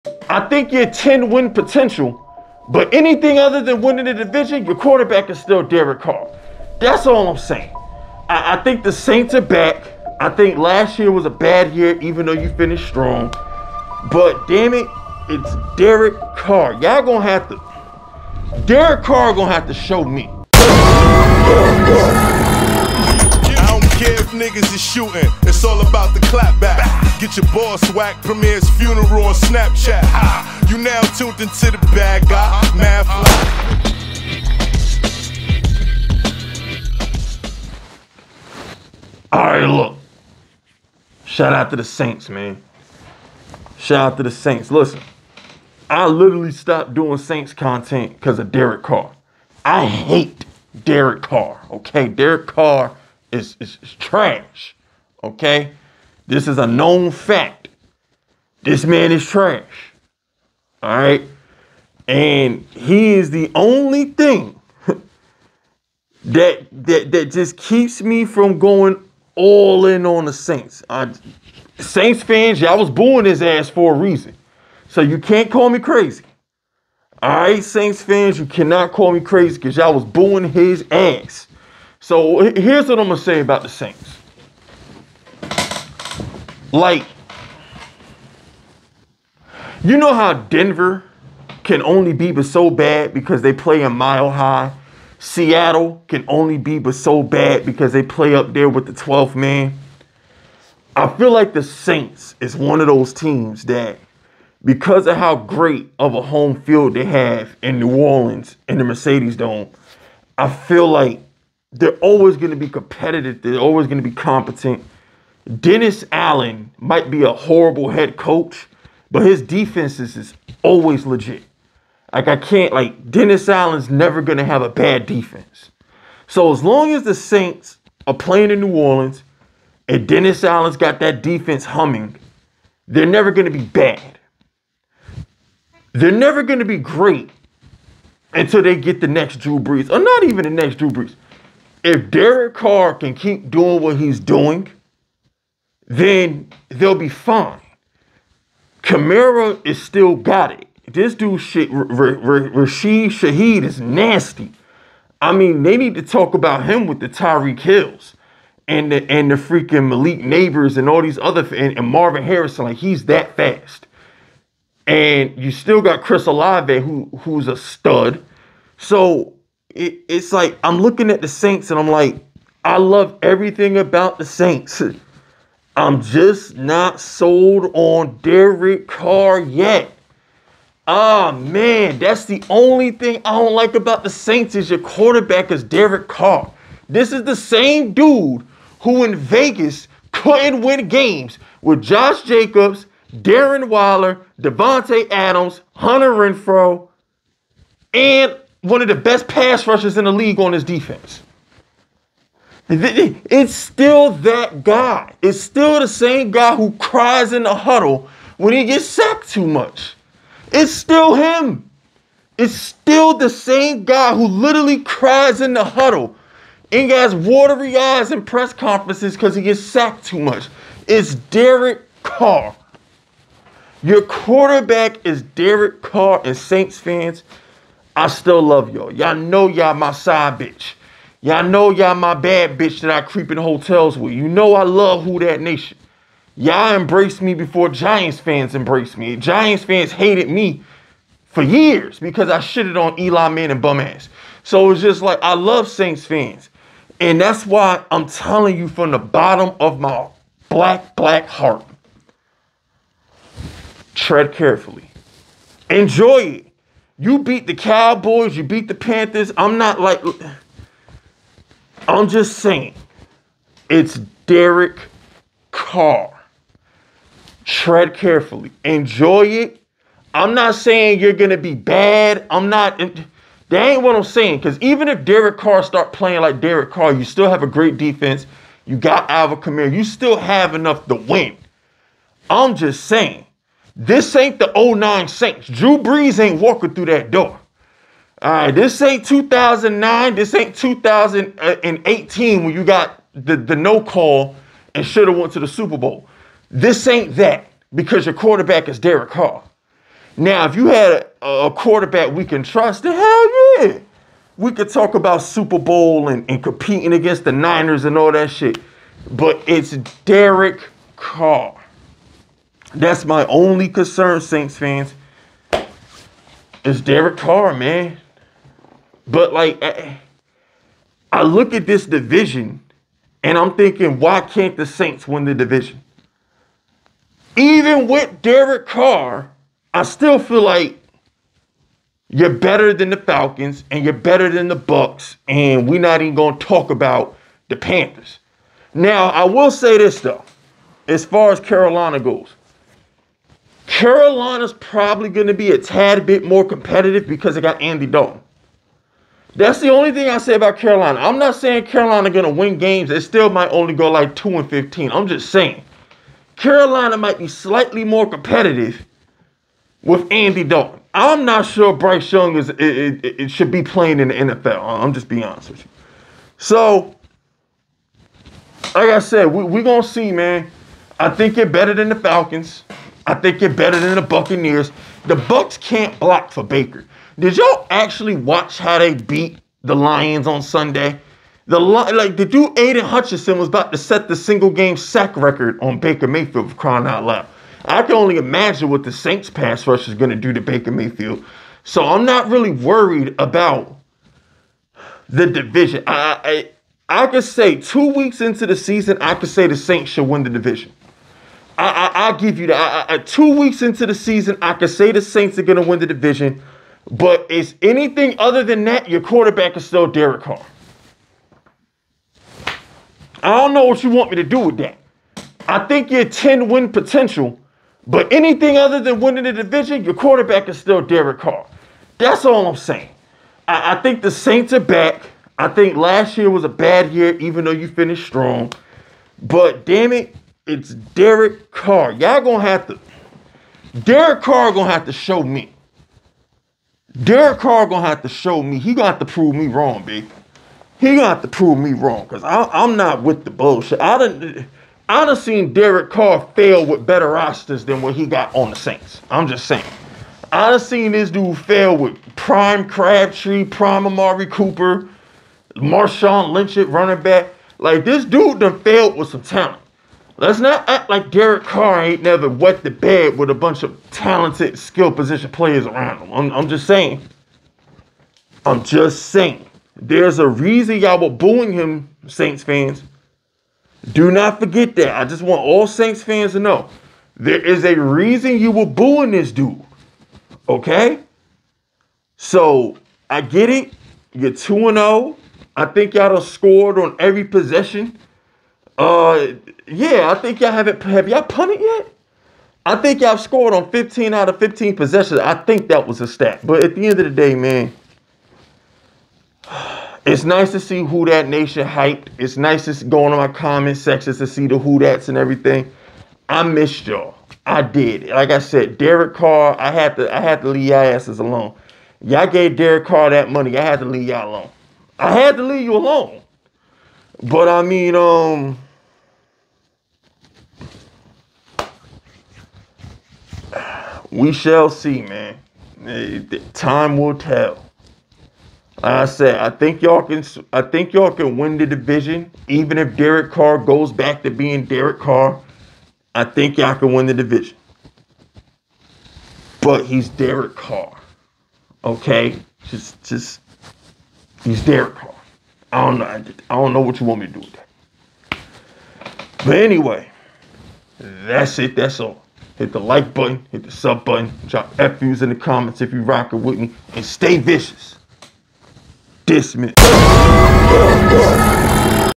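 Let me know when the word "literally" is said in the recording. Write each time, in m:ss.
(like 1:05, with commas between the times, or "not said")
0:46, 3:34.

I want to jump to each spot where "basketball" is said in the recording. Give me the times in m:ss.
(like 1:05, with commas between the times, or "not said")
not said.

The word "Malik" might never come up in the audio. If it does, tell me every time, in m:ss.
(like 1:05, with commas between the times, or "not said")
2:39.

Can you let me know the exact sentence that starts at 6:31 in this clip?
So I'm not really worried about the division.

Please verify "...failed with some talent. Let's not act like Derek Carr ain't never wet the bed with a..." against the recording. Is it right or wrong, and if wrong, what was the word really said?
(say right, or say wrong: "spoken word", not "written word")
right.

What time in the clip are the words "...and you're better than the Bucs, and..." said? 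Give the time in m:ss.
5:33.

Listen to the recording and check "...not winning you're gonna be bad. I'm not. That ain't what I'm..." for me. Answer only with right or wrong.
wrong.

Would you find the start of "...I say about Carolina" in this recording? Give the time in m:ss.
5:50.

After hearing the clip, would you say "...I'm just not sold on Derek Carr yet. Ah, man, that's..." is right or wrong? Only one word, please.
right.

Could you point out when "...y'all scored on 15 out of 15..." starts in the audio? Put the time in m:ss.
8:13.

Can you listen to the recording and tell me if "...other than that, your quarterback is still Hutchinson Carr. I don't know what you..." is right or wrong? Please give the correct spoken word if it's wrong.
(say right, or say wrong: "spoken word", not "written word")
wrong: "Derek", not "Hutchinson".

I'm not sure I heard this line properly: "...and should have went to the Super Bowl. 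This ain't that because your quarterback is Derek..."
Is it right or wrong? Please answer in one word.
right.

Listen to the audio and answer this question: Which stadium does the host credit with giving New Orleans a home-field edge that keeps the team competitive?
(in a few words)
Mercedes Dome.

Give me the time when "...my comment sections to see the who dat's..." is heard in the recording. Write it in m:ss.
8:23.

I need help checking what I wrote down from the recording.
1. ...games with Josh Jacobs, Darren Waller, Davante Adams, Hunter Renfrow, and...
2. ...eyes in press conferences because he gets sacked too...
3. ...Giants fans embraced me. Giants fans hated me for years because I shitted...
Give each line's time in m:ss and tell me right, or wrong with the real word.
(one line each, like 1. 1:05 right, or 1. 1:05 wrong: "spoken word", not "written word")
1. 3:10 right
2. 3:37 right
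3. 3:57 right.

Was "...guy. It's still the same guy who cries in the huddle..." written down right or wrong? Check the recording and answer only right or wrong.
right.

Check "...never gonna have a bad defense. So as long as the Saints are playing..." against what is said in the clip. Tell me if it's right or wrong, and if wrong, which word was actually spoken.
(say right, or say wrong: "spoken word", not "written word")
right.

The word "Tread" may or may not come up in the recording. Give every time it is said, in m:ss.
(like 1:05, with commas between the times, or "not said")
4:13, 4:27.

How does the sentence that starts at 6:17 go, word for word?
Did y'all actually watch how they beat the Lions on Sunday?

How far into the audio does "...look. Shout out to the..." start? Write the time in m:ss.
0:39.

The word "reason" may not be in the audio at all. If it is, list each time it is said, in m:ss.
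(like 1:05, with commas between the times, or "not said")
1:13, 7:50, 7:57.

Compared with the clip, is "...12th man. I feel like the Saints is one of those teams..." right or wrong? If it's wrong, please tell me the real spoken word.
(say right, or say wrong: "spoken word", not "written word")
right.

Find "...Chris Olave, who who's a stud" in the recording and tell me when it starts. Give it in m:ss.
2:46.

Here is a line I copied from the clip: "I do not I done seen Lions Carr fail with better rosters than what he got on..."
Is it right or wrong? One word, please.
wrong.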